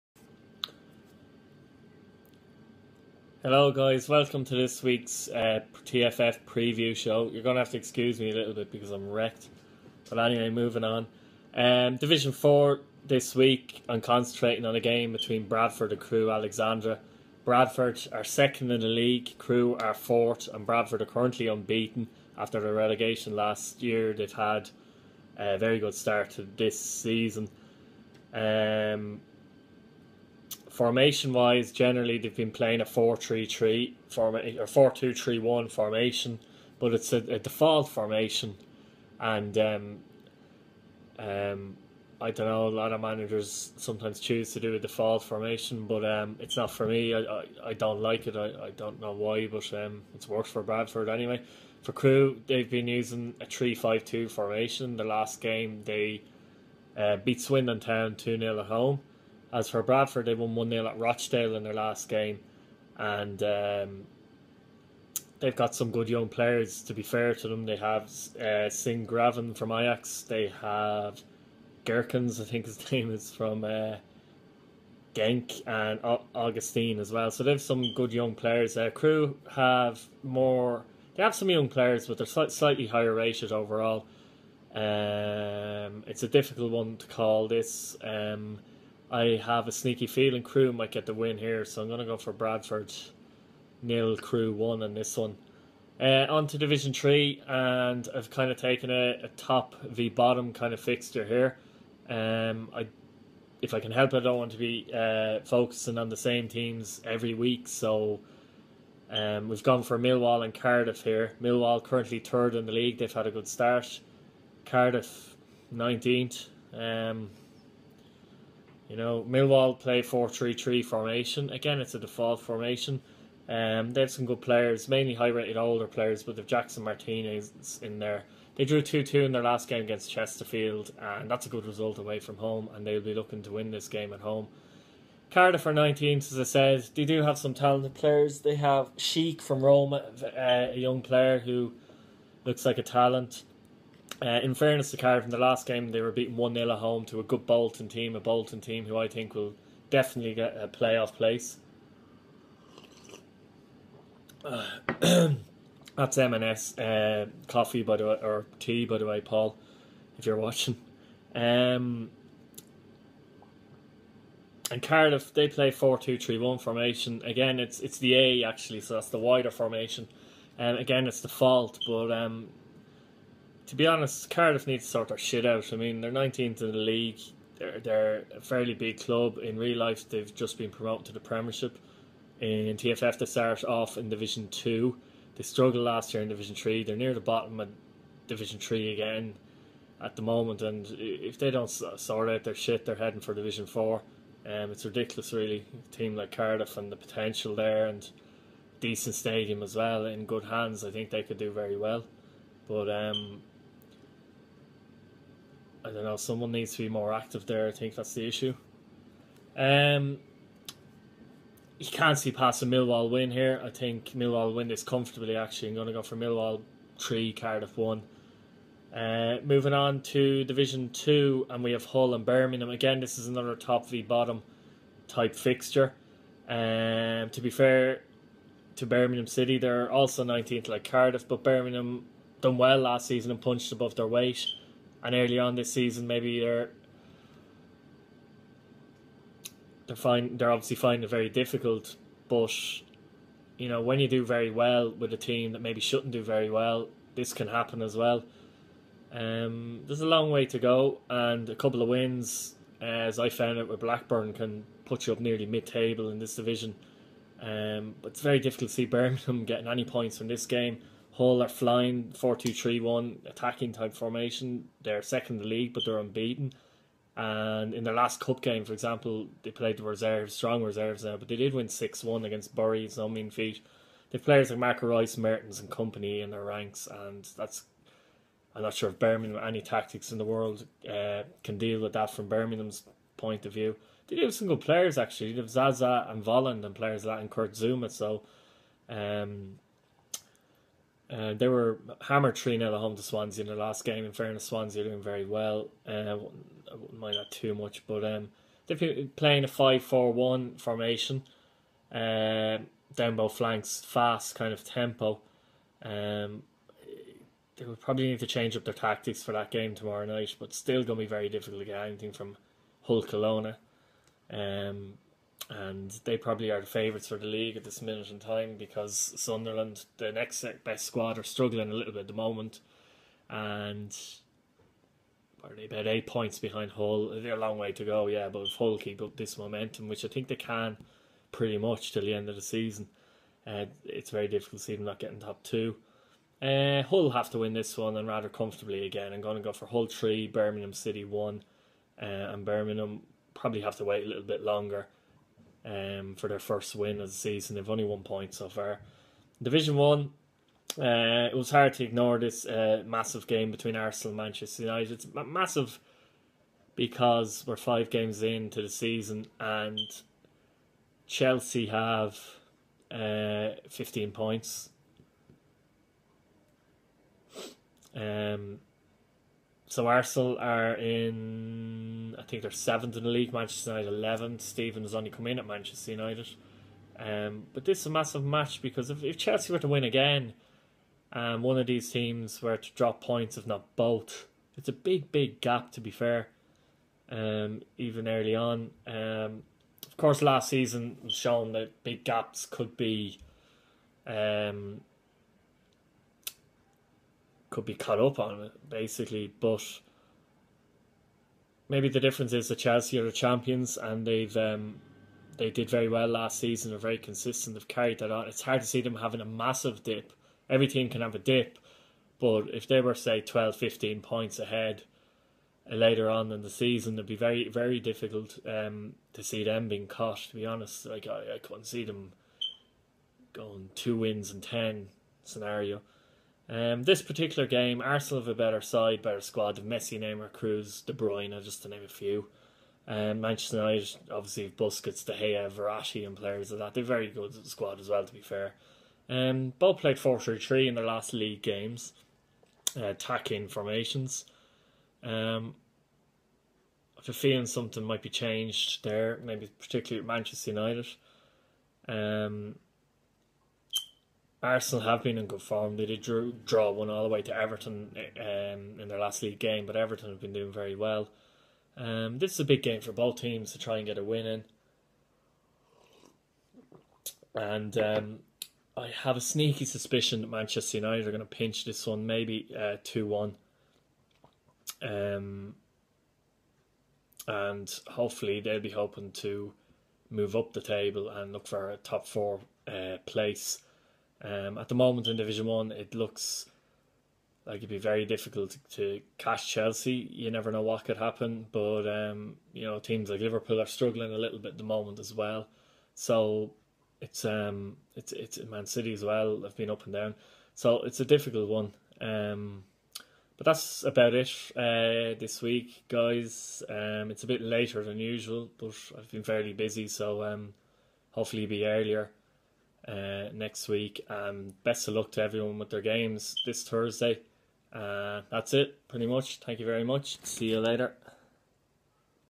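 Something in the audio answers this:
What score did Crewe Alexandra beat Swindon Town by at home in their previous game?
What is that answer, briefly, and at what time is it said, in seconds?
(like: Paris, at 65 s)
2-0, at 58 s.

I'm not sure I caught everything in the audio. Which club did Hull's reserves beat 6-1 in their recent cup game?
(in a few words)
Bury.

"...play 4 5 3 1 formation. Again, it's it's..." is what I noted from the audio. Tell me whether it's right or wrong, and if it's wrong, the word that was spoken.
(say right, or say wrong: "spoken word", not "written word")
wrong: "2", not "5".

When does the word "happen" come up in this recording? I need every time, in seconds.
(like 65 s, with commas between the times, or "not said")
247 s, 490 s.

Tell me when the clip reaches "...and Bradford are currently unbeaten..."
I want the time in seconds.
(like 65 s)
20 s.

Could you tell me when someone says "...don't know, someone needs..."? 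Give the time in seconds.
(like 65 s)
205 s.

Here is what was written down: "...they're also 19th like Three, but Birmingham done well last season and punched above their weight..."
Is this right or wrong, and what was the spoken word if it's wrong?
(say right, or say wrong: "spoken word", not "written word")
wrong: "Cardiff", not "Three".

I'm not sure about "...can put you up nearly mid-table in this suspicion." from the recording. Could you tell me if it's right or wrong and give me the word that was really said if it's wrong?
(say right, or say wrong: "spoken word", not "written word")
wrong: "division", not "suspicion".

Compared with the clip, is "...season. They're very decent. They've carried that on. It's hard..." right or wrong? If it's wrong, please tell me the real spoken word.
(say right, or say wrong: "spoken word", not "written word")
wrong: "consistent", not "decent".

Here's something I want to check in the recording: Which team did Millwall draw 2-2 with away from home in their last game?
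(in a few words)
Chesterfield.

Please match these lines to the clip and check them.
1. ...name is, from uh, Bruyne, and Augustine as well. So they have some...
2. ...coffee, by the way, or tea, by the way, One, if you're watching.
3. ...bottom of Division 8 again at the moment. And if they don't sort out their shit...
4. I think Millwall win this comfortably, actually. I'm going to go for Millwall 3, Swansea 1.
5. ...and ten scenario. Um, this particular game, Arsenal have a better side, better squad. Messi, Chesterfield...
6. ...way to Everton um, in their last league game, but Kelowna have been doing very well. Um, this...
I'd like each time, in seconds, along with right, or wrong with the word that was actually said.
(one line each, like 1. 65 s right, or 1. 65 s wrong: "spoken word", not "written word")
1. 72 s wrong: "Genk", not "Bruyne"
2. 157 s wrong: "Paul", not "One"
3. 187 s wrong: "3", not "8"
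4. 213 s wrong: "Cardiff", not "Swansea"
5. 424 s wrong: "Neymar", not "Chesterfield"
6. 457 s wrong: "Everton", not "Kelowna".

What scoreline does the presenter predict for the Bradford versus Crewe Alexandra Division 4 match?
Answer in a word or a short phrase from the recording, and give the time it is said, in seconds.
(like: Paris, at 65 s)
Bradford 0, Crewe 1, at 92 s.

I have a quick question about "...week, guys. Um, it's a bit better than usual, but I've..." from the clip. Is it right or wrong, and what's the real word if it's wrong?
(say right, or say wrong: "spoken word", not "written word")
wrong: "later", not "better".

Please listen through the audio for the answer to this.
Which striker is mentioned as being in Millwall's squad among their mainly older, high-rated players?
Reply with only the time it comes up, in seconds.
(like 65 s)
126 s.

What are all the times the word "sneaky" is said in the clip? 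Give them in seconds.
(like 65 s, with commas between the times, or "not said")
89 s, 469 s.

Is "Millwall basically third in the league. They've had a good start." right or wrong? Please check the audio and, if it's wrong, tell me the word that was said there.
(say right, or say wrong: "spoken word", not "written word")
wrong: "currently", not "basically".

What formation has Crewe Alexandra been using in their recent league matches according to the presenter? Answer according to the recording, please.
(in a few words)
3-5-2.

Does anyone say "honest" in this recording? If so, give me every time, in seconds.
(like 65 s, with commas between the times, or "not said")
173 s, 420 s.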